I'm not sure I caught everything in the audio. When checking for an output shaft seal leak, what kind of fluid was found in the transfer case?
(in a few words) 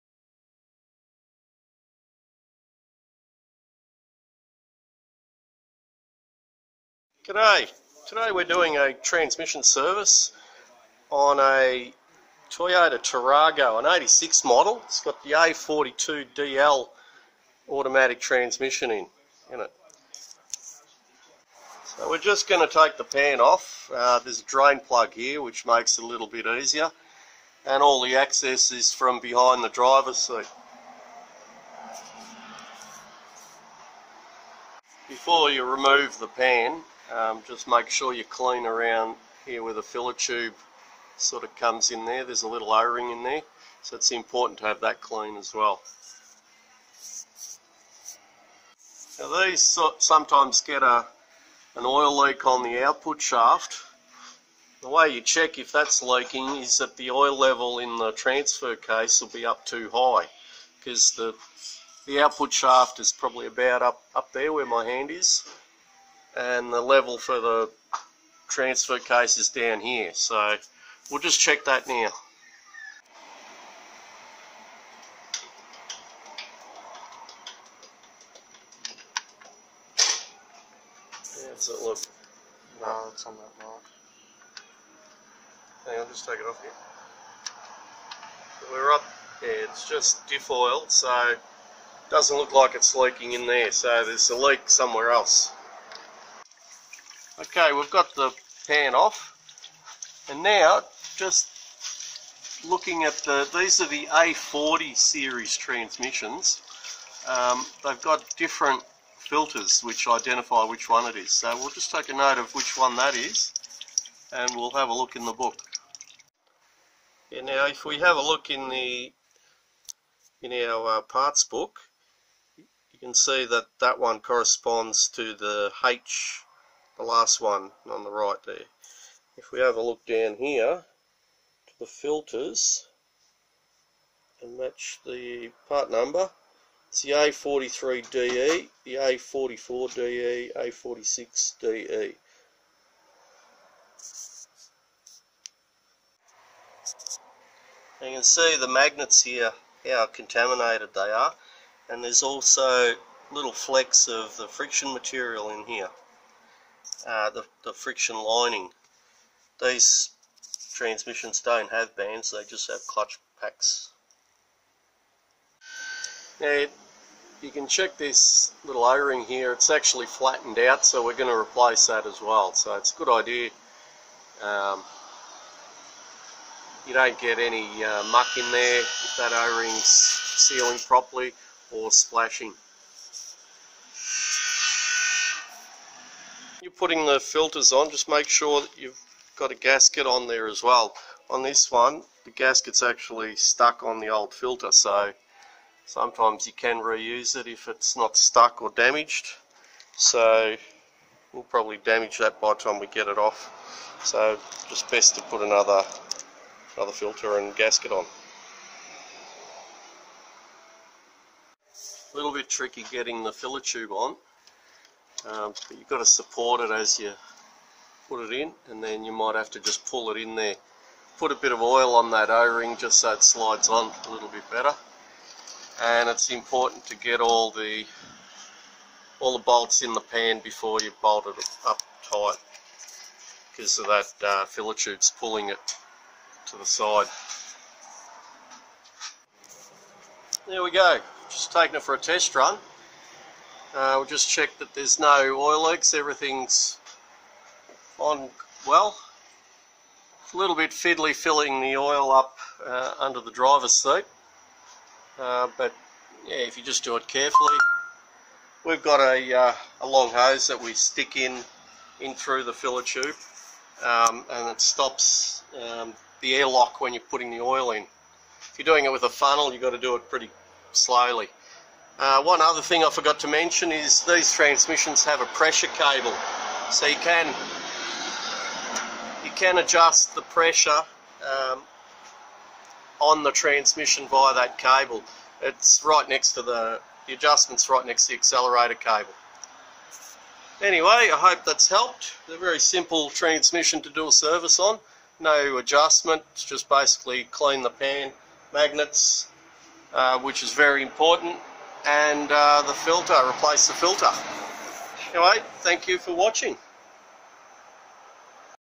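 Diff oil.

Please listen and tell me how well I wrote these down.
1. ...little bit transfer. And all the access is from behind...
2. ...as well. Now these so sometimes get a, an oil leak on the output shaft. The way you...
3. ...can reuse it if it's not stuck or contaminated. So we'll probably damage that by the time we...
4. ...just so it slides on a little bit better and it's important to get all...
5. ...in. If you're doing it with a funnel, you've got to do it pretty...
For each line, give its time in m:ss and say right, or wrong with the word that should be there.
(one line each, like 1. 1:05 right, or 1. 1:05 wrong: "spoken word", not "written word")
1. 0:26 wrong: "easier", not "transfer"
2. 0:45 right
3. 3:16 wrong: "damaged", not "contaminated"
4. 3:42 right
5. 4:27 right.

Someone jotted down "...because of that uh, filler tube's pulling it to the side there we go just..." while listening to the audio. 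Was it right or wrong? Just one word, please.
right.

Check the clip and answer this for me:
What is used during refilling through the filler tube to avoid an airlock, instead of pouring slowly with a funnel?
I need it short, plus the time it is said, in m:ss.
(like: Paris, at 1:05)
A long hose, at 4:19.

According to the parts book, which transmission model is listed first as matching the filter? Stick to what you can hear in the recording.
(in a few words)
A43DE.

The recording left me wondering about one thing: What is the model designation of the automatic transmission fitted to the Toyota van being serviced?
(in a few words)
A42DL.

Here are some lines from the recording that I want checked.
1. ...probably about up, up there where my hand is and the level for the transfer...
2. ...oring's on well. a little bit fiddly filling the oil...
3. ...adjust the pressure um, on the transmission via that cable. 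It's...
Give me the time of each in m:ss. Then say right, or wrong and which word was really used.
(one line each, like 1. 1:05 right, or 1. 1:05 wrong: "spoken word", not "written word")
1. 1:03 right
2. 4:05 wrong: "everything", not "oring"
3. 4:39 right.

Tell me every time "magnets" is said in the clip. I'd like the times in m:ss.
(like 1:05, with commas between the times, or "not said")
2:28, 4:58.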